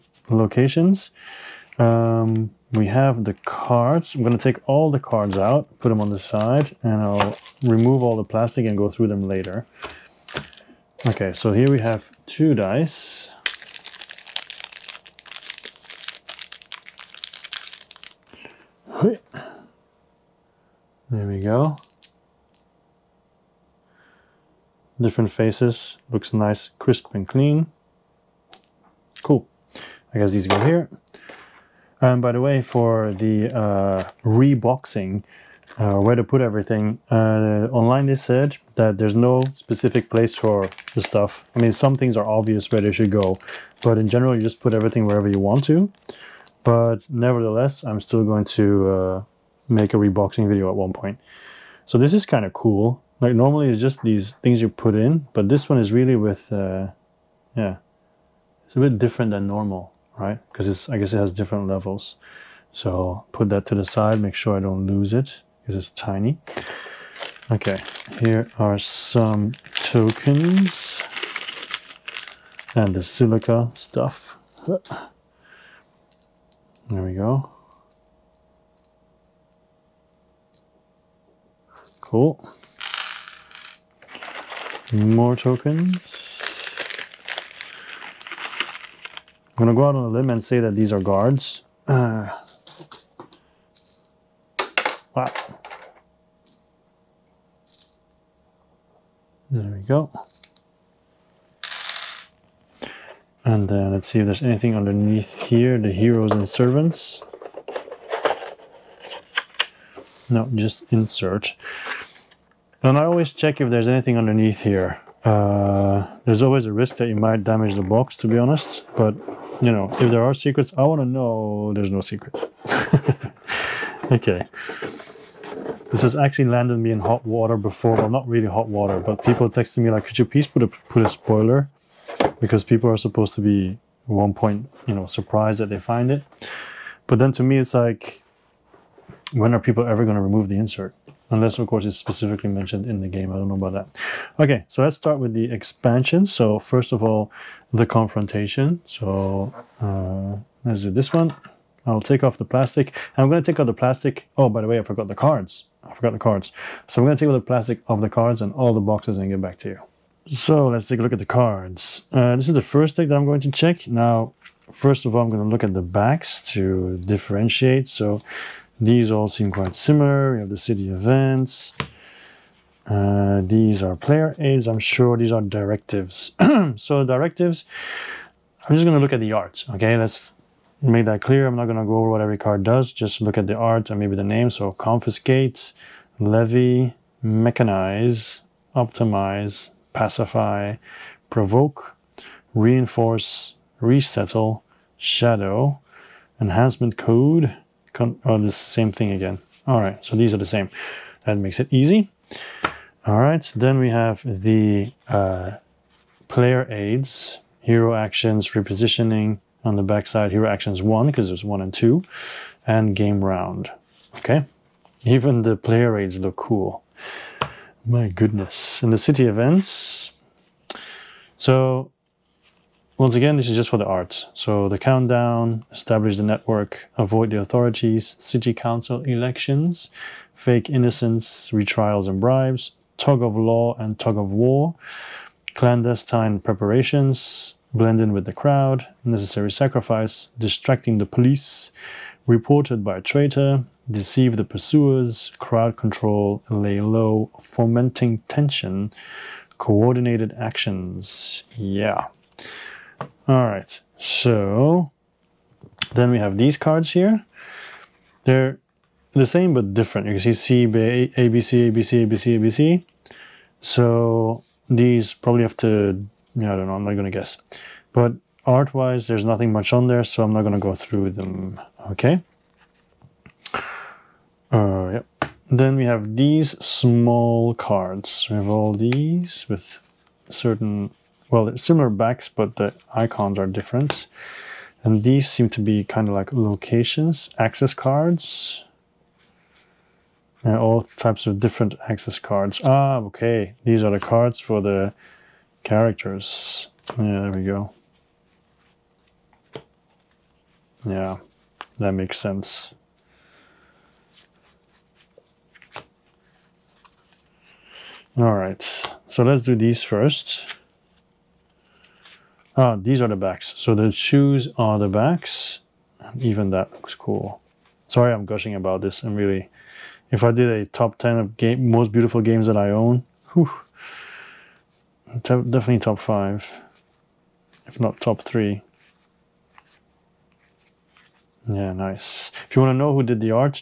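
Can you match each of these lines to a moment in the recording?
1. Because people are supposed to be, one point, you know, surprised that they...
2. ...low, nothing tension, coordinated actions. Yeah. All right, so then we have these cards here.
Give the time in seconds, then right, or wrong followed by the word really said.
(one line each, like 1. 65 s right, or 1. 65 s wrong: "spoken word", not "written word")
1. 132 s right
2. 246 s wrong: "fomenting", not "nothing".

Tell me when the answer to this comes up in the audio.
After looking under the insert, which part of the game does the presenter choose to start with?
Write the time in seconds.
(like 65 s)
147 s.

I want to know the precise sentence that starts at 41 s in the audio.
I mean, some things are obvious where they should go, but in general, you just put everything wherever you want to.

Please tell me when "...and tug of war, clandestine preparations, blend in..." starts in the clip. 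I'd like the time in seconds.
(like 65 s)
233 s.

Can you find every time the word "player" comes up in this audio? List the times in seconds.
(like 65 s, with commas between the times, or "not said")
173 s, 206 s, 215 s.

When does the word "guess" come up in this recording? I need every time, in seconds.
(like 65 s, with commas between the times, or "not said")
30 s, 60 s, 267 s.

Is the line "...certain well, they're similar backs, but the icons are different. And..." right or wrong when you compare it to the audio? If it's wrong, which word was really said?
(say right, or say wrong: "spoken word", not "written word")
right.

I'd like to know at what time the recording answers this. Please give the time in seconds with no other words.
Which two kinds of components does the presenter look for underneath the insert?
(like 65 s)
105 s.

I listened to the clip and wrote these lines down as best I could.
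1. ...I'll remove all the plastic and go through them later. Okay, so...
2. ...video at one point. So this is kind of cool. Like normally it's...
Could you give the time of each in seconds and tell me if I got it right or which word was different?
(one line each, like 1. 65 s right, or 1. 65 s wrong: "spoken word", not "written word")
1. 7 s right
2. 50 s right.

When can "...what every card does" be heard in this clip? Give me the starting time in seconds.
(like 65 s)
182 s.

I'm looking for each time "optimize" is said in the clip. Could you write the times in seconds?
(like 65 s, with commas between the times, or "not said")
188 s.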